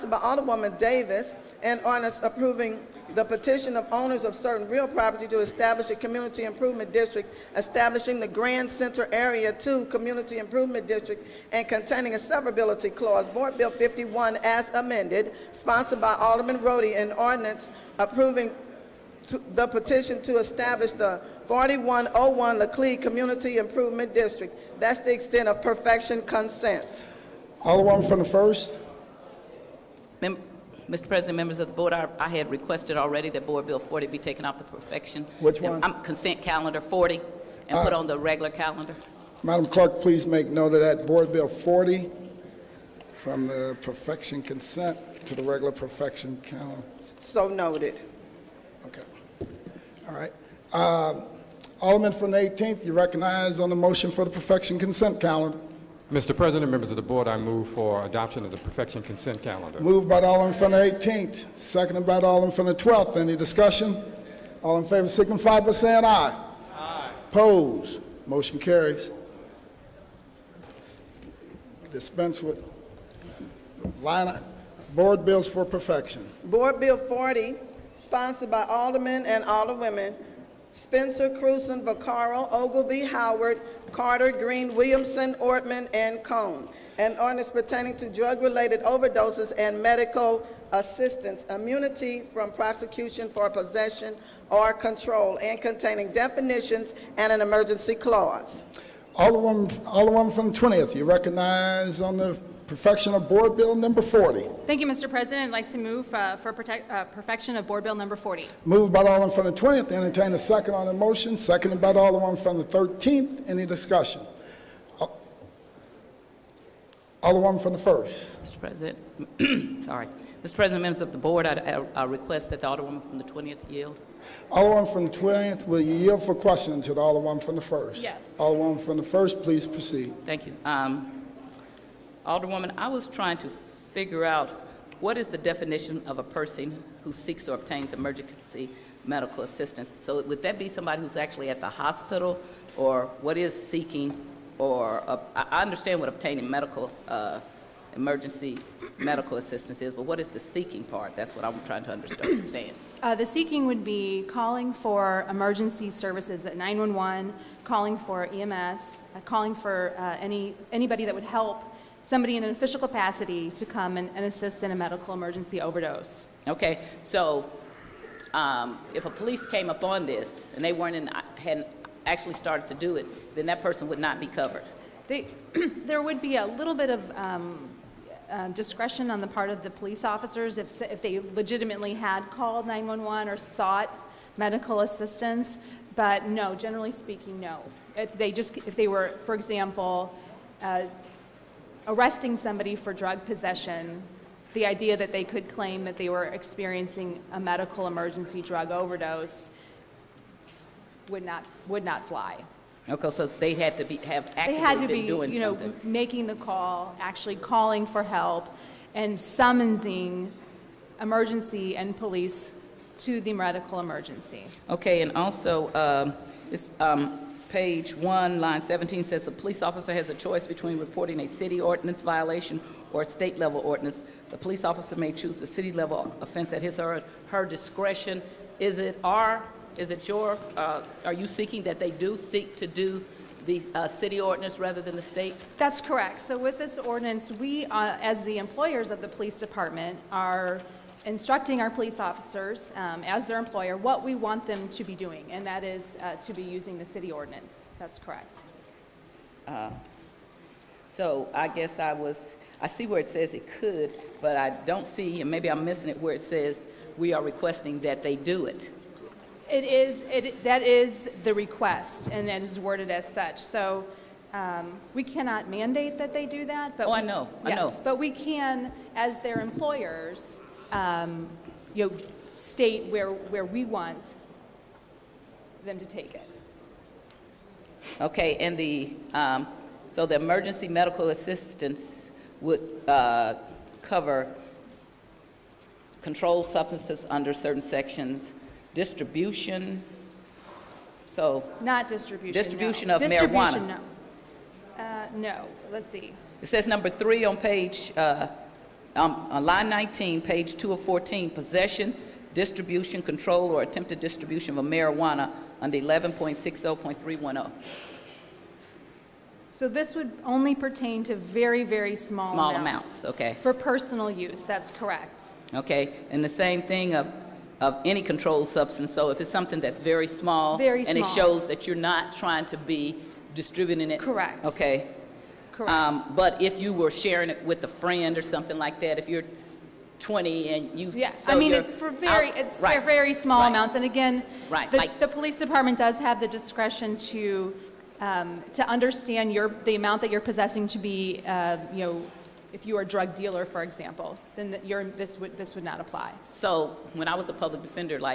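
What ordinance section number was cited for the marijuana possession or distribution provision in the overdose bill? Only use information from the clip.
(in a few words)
11.60.310.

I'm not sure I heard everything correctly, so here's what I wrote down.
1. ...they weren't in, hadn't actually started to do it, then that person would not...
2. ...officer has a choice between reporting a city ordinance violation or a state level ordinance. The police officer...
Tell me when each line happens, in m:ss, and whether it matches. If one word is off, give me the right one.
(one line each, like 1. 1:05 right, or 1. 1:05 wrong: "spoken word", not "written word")
1. 2:50 right
2. 3:39 right.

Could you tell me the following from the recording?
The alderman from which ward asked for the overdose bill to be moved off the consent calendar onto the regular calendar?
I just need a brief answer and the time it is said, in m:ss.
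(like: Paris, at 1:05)
1st, at 0:28.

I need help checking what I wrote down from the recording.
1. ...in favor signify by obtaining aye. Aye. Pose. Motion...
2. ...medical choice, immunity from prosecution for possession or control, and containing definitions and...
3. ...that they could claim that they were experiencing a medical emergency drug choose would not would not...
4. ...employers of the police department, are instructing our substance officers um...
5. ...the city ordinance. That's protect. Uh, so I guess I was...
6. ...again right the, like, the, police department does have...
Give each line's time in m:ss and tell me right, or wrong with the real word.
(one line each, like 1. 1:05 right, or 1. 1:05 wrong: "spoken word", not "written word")
1. 1:04 wrong: "saying", not "obtaining"
2. 1:29 wrong: "assistance", not "choice"
3. 3:14 wrong: "overdose", not "choose"
4. 3:58 wrong: "police", not "substance"
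5. 4:06 wrong: "correct", not "protect"
6. 5:33 right.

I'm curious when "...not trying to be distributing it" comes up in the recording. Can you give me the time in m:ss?
5:21.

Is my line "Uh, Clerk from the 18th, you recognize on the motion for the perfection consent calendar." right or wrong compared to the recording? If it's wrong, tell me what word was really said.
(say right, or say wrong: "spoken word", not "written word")
wrong: "Alderman", not "Clerk".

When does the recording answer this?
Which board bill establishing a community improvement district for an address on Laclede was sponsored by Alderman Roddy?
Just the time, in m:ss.
0:13.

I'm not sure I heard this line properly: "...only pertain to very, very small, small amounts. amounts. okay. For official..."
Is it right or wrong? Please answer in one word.
wrong.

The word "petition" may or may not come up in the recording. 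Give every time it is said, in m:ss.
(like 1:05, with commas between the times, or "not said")
0:03, 0:19.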